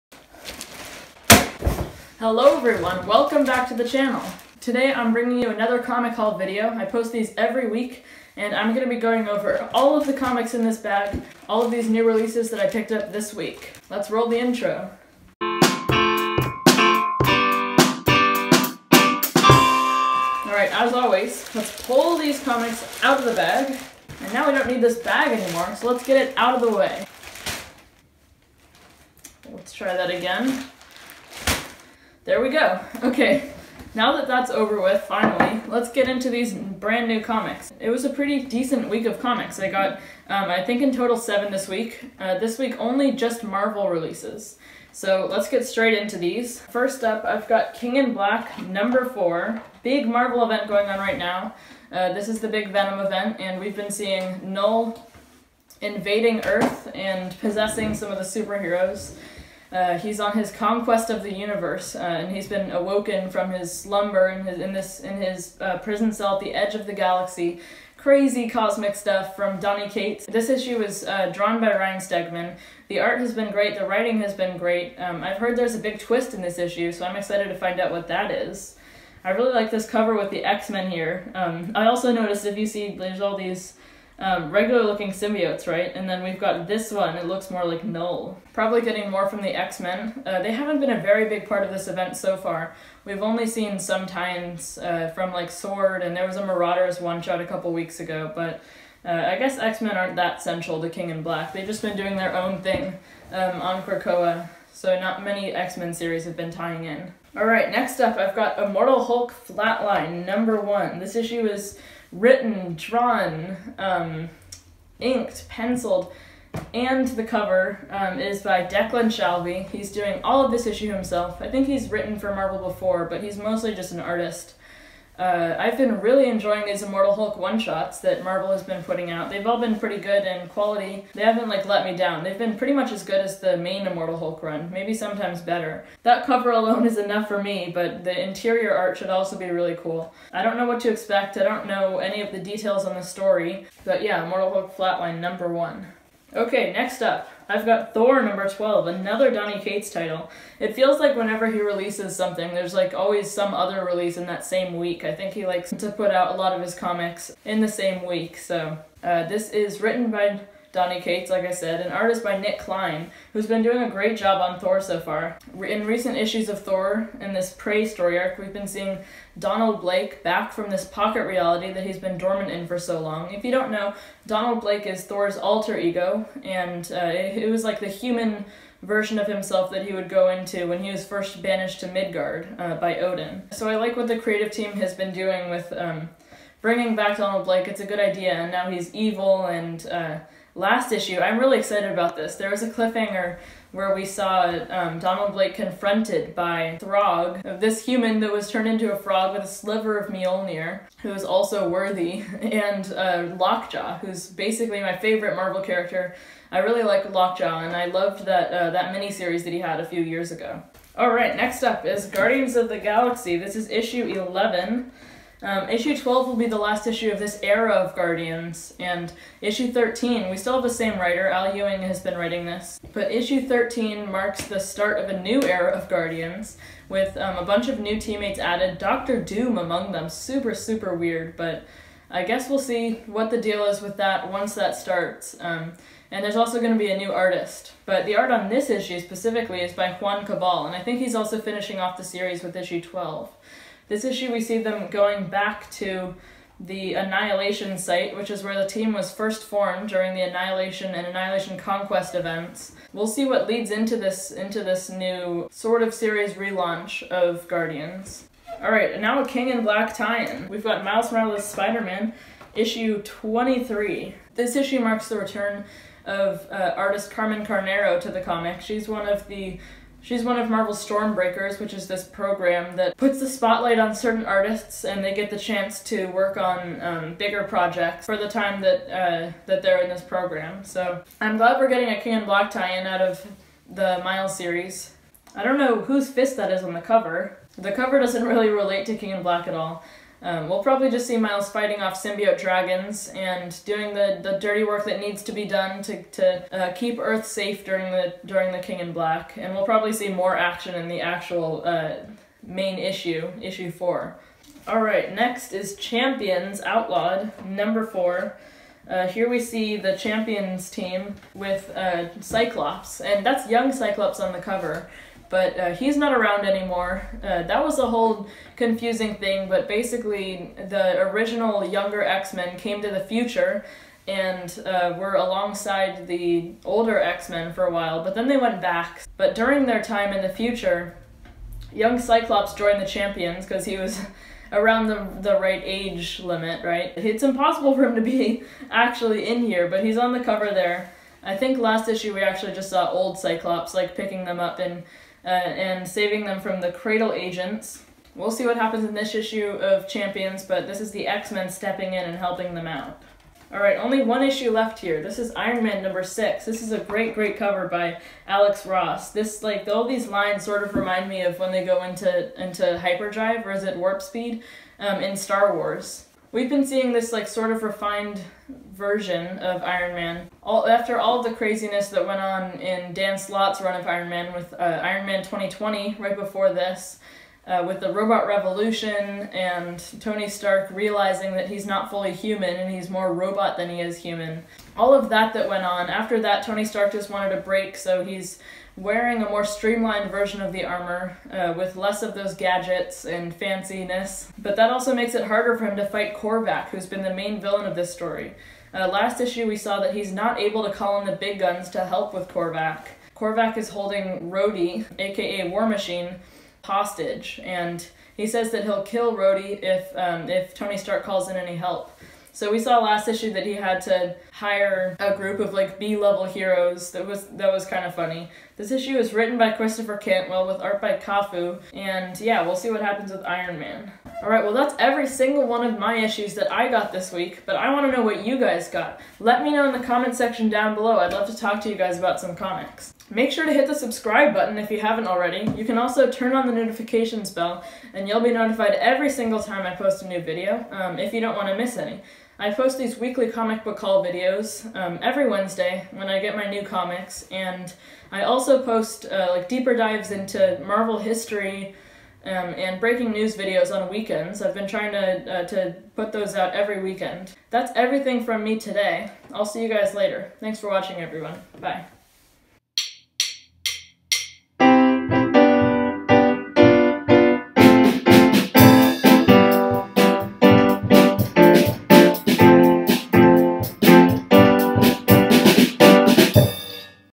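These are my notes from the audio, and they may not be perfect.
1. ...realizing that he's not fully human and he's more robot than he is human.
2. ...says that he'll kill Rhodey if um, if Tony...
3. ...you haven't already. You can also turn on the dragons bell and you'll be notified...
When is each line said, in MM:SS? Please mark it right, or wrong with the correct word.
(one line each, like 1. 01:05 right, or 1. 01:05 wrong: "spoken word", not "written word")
1. 06:20 right
2. 06:48 right
3. 07:14 wrong: "notifications", not "dragons".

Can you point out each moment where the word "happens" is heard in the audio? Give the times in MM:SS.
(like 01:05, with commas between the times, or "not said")
05:48, 07:02.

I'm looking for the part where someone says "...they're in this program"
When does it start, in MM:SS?
04:39.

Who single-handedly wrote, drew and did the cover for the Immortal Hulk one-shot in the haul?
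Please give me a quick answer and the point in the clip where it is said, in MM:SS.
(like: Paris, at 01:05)
Declan Shalvey, at 01:58.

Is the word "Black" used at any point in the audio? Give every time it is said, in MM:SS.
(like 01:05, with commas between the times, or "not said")
00:48, 01:41, 04:19, 04:49, 04:58.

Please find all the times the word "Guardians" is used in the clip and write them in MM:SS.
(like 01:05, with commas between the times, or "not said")
03:32, 03:37, 03:45, 04:17.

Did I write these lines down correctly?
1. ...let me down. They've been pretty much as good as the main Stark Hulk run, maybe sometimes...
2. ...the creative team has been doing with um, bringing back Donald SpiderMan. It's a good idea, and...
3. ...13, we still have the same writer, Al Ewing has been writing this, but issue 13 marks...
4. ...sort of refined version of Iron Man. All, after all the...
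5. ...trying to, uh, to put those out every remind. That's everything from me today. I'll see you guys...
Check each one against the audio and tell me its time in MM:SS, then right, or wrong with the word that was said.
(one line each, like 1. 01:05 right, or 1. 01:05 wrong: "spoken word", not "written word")
1. 02:11 wrong: "Immortal", not "Stark"
2. 03:04 wrong: "Blake", not "SpiderMan"
3. 03:39 right
4. 06:07 right
5. 07:34 wrong: "weekend", not "remind".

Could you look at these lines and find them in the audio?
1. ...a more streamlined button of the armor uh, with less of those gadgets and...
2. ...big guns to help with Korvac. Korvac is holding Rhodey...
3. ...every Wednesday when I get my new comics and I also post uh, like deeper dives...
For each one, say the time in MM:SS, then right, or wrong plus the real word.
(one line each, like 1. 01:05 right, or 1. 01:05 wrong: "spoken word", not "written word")
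1. 06:29 wrong: "version", not "button"
2. 06:41 right
3. 07:25 right.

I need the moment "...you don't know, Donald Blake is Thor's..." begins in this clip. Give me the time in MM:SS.
02:53.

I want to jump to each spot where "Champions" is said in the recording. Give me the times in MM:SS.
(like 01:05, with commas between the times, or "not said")
05:05, 05:09, 05:32, 05:49.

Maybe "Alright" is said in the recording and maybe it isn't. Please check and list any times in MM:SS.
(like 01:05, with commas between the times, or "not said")
00:20, 01:47, 05:53.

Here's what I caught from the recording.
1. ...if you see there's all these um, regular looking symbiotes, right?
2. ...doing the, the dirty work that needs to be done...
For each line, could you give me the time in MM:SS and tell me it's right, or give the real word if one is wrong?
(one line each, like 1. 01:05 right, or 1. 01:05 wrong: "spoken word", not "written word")
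1. 01:22 right
2. 04:53 right.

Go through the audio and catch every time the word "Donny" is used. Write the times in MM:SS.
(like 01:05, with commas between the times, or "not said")
01:09, 02:29, 02:40.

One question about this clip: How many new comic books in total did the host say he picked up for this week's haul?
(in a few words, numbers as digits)
7.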